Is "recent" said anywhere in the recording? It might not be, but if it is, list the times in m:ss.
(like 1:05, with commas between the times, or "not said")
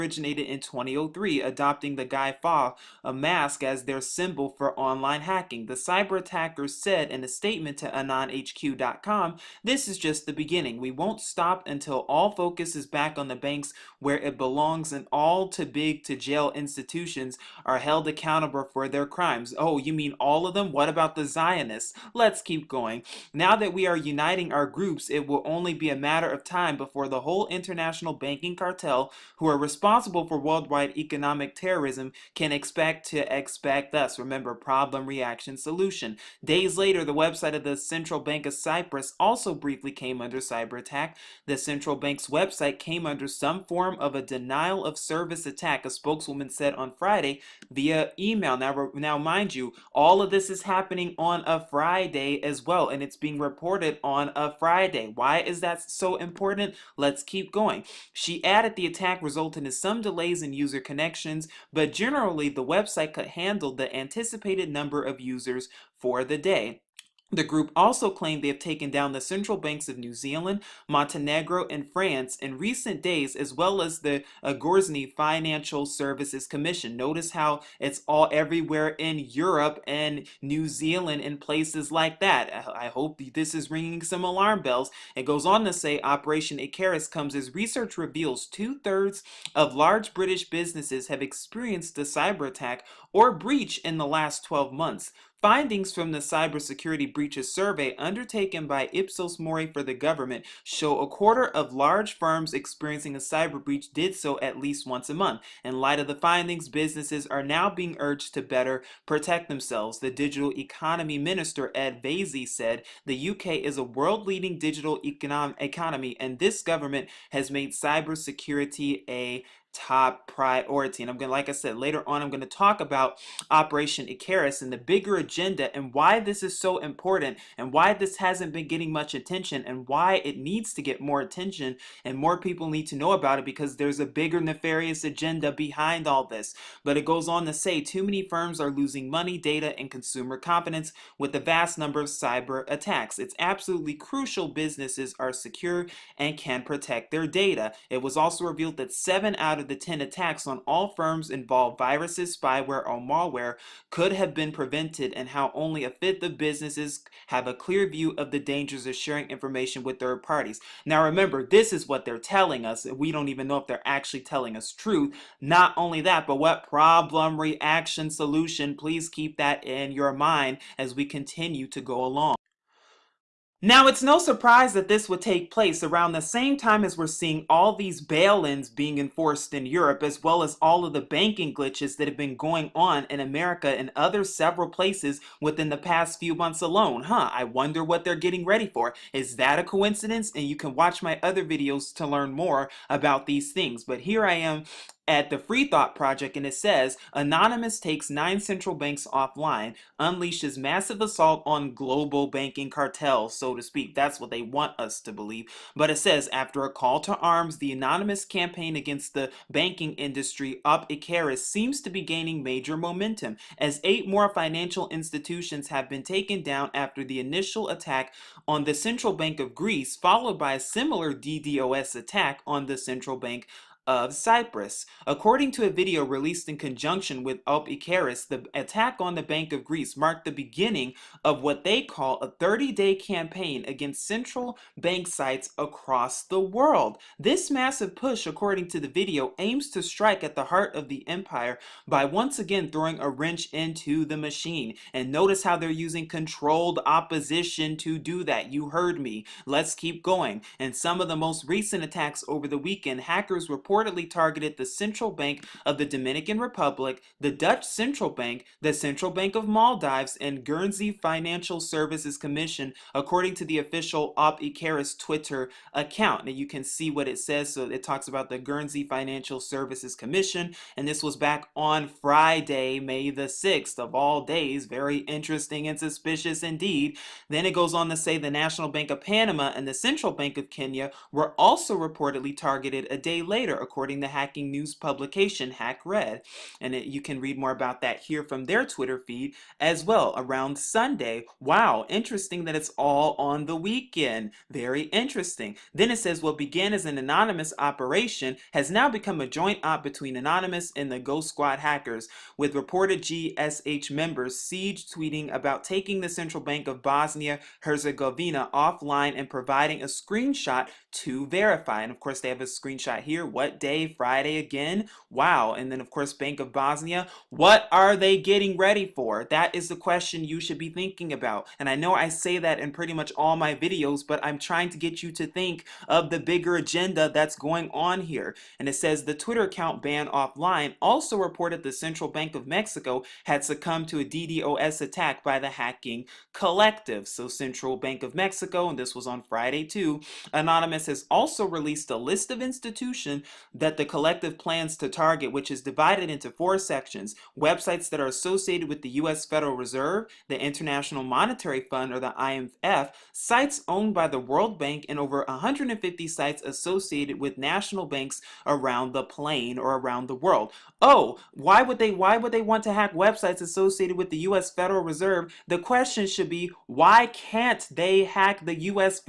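1:12, 4:11.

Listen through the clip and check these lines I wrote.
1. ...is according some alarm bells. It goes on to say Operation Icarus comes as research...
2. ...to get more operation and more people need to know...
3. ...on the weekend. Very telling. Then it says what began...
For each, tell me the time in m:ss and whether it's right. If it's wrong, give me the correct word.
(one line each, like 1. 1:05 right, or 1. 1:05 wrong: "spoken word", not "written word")
1. 1:23 wrong: "ringing", not "according"
2. 2:10 wrong: "attention", not "operation"
3. 4:53 wrong: "interesting", not "telling".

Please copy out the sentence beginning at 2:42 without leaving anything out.
We don't even know if they're actually telling us truth.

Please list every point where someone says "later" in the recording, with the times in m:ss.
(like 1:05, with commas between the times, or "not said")
0:36, 2:01, 4:43.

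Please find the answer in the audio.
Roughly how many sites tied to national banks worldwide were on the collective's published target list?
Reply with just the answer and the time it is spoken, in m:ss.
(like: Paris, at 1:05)
over 150, at 5:54.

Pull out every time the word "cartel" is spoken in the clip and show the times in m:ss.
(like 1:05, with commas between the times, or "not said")
0:28, 3:22.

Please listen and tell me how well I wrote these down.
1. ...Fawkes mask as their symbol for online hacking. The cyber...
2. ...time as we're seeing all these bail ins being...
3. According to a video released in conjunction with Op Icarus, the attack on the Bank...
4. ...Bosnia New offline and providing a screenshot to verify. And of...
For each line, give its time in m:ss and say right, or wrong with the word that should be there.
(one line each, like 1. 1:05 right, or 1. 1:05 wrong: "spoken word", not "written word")
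1. 0:02 right
2. 2:56 right
3. 3:45 right
4. 5:06 wrong: "Herzegovina", not "New".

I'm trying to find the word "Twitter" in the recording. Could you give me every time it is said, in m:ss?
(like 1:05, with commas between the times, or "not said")
4:24, 4:48, 5:29.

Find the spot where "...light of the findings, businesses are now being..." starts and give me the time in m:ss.
1:45.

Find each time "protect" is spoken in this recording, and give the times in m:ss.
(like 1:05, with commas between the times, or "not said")
1:49, 2:26.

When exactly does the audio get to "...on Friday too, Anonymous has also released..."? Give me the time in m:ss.
5:39.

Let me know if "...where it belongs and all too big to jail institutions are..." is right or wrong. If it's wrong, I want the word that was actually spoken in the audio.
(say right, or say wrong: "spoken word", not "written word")
right.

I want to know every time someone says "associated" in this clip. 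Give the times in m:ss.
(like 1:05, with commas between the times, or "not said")
5:48, 5:56, 6:03.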